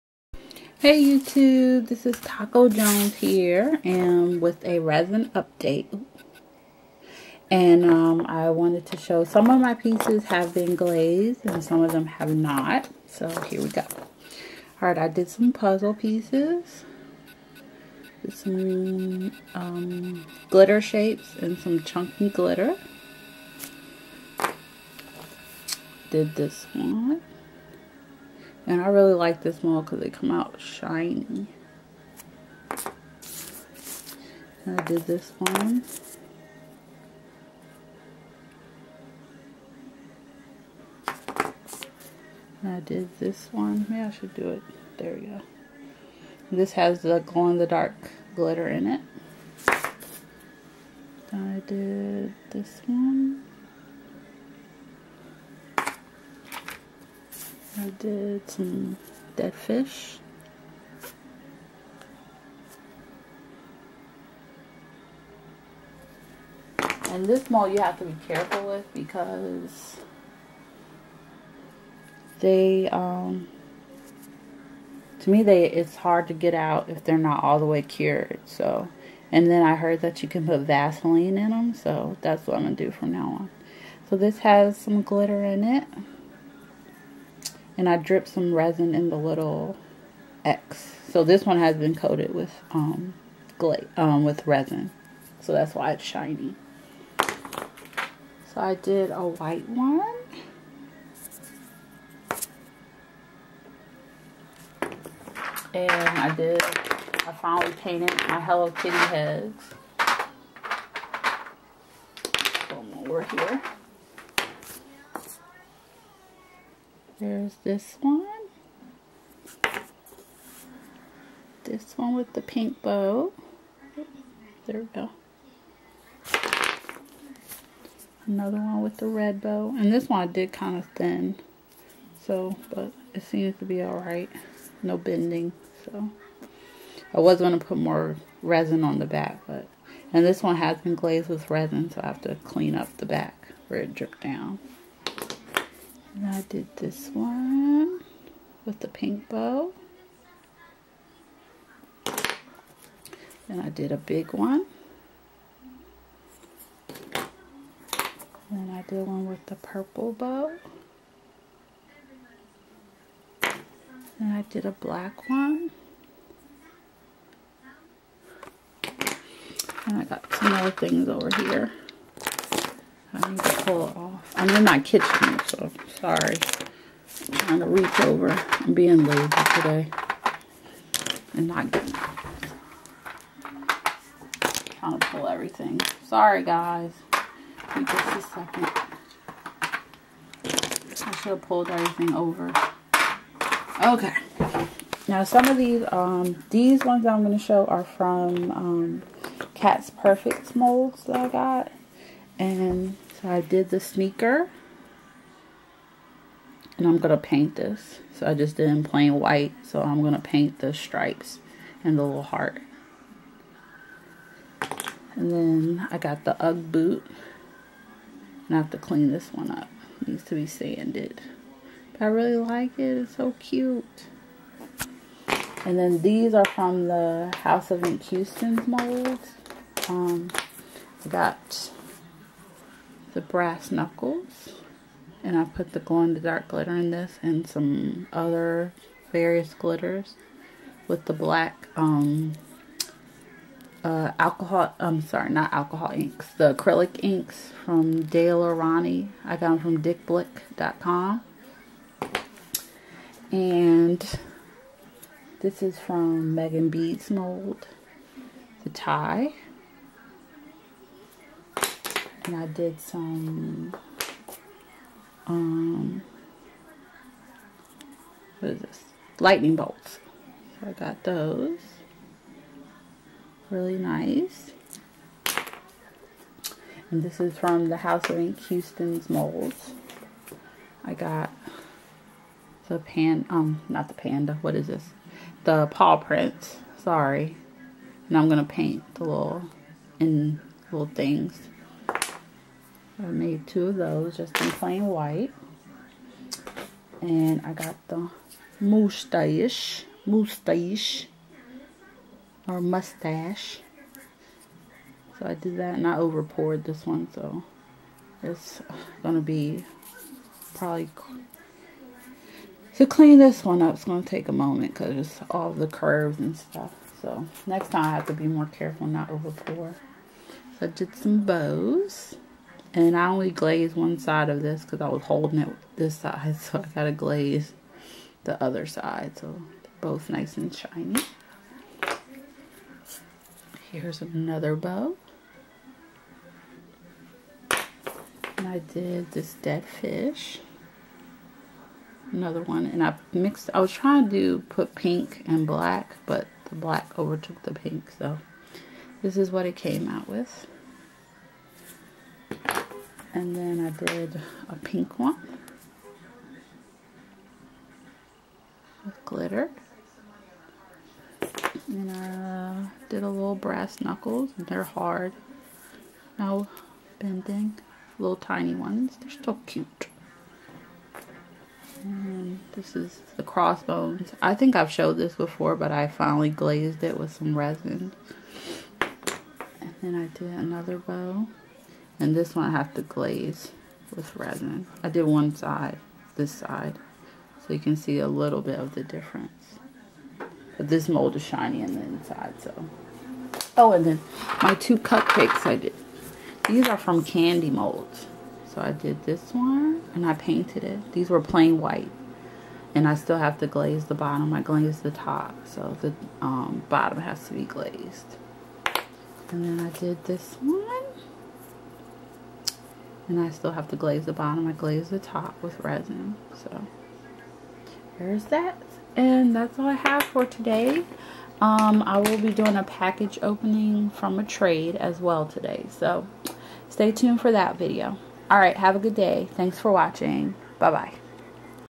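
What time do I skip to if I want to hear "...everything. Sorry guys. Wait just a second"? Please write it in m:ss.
3:05.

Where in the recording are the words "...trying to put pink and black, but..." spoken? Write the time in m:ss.
5:43.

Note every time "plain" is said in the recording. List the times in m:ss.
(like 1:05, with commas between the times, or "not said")
3:28, 4:54, 6:41.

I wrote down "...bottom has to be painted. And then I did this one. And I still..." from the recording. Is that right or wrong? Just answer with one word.
wrong.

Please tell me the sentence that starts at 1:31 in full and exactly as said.
So this one has been coated with um, um, with resin.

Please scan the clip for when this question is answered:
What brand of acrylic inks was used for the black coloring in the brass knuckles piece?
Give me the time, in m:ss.
4:08.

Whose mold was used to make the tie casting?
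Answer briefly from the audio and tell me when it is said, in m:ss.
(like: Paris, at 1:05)
Megan Beads, at 4:16.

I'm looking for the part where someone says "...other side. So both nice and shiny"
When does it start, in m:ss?
5:28.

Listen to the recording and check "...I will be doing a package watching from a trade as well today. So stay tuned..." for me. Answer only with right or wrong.
wrong.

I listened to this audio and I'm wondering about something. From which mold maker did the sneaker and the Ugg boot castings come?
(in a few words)
Cat's Perfect.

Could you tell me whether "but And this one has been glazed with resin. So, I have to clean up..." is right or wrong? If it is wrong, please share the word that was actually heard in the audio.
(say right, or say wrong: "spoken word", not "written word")
right.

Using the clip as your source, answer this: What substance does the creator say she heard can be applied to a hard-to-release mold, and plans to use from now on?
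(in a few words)
Vaseline.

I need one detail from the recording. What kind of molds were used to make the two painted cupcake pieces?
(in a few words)
candy molds.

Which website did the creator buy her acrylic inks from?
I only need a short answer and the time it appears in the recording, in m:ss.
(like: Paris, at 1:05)
dickblick.com, at 4:09.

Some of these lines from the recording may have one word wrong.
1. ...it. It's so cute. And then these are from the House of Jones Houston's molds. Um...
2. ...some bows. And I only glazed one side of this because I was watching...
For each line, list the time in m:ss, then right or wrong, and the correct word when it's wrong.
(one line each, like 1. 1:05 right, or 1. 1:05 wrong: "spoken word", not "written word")
1. 3:42 wrong: "Ink", not "Jones"
2. 5:20 wrong: "holding", not "watching".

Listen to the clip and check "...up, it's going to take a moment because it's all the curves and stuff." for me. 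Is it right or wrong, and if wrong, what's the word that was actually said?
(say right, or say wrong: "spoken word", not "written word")
right.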